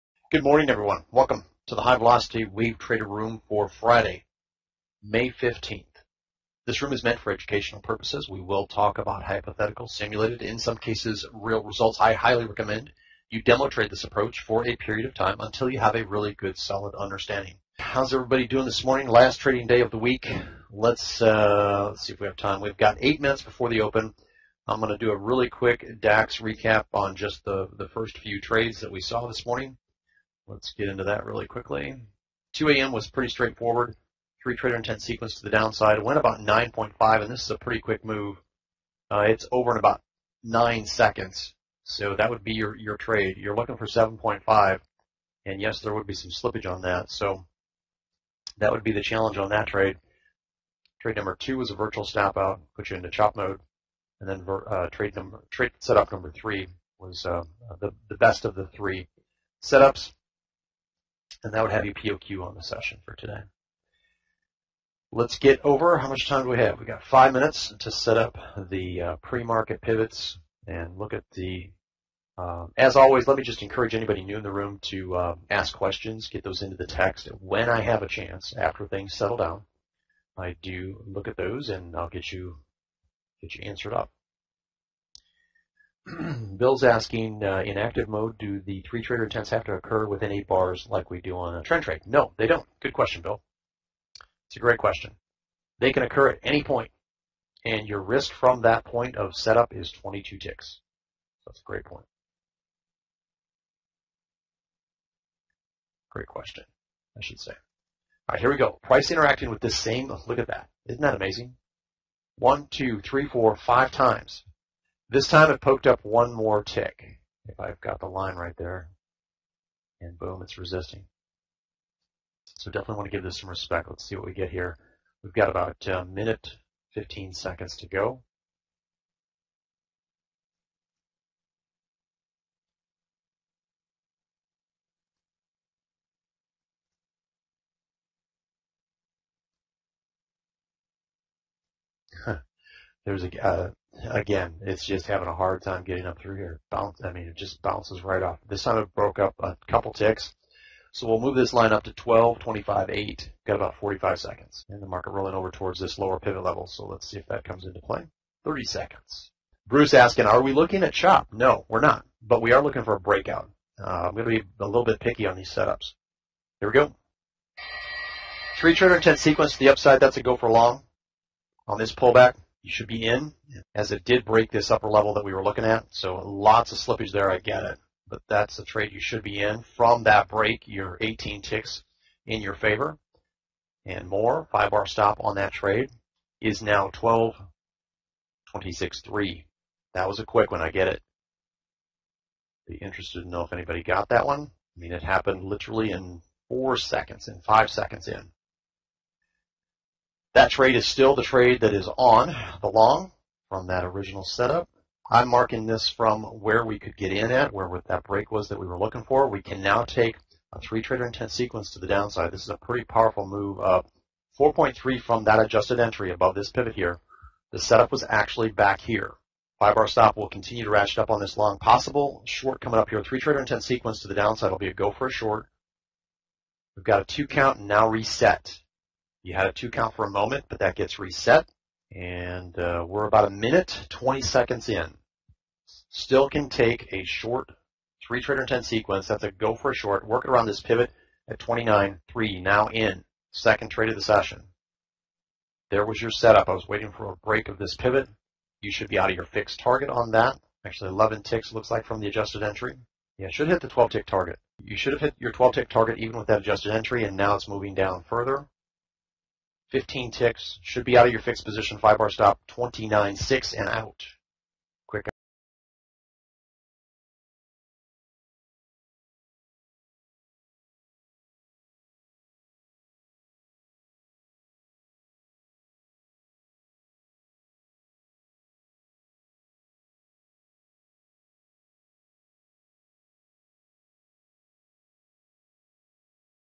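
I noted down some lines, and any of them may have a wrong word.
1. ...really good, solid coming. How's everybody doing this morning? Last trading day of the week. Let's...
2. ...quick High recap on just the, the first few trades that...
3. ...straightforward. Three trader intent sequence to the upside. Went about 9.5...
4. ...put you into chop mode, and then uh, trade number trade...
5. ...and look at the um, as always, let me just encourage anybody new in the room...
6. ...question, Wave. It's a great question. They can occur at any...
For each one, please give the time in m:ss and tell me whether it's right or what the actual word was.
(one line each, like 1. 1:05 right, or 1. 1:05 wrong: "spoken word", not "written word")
1. 0:16 wrong: "understanding", not "coming"
2. 0:25 wrong: "DAX", not "High"
3. 0:33 wrong: "downside", not "upside"
4. 0:52 right
5. 1:10 right
6. 1:32 wrong: "Bill", not "Wave".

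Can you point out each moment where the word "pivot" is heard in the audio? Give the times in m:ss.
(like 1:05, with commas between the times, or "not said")
1:09, 2:36, 3:36, 4:00, 4:07.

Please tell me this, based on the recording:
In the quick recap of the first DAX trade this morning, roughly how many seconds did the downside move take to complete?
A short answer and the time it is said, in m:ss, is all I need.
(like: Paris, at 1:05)
9 seconds, at 0:40.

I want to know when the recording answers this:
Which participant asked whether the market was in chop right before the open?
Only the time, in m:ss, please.
2:39.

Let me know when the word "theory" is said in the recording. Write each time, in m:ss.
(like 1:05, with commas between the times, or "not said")
not said.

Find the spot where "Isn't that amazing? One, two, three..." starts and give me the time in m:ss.
1:50.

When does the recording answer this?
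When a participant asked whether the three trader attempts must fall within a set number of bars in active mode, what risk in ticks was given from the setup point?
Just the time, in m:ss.
1:39.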